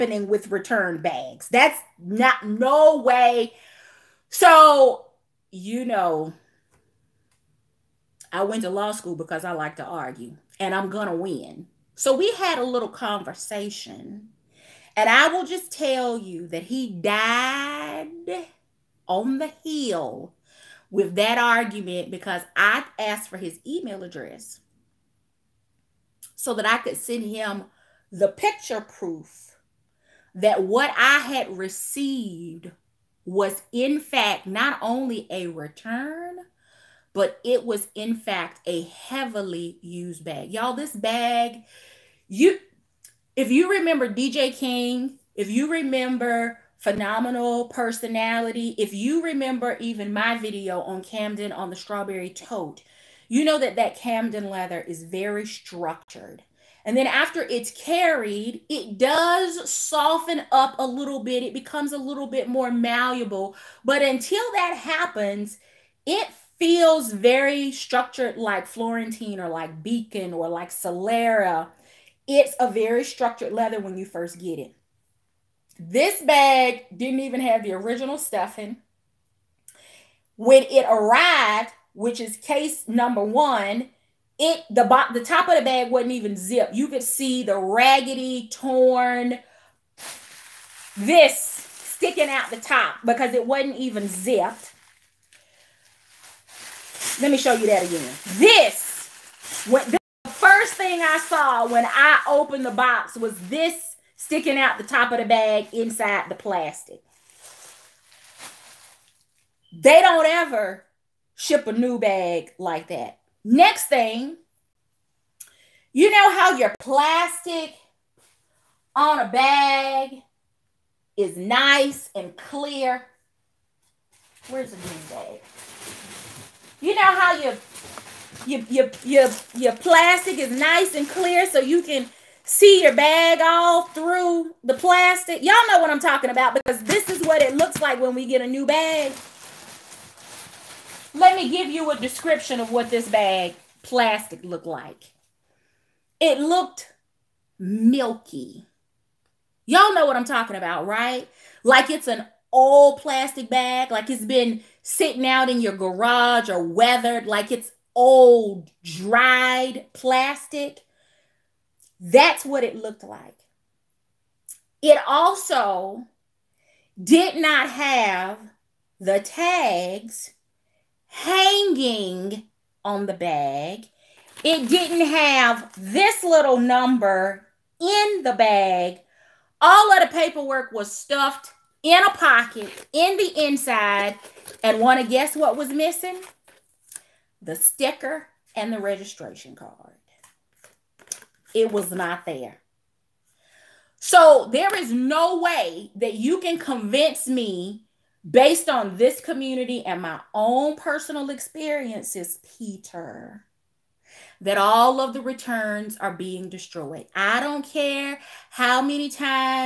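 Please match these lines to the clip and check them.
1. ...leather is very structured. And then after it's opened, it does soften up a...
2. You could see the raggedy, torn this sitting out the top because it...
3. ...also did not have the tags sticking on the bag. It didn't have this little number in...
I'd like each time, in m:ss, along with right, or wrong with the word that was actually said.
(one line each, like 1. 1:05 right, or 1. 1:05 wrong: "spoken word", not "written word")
1. 0:54 wrong: "carried", not "opened"
2. 1:26 wrong: "sticking", not "sitting"
3. 2:45 wrong: "hanging", not "sticking".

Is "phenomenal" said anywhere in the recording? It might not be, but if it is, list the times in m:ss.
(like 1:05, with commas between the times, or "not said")
0:46.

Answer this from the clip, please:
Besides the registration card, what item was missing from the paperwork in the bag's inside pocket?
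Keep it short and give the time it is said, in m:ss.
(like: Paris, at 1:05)
The sticker, at 3:07.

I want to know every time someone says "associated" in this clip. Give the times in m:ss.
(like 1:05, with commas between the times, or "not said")
not said.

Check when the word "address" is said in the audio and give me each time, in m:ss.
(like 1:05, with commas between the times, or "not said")
0:24.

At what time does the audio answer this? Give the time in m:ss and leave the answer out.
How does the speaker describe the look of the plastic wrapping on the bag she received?
2:27.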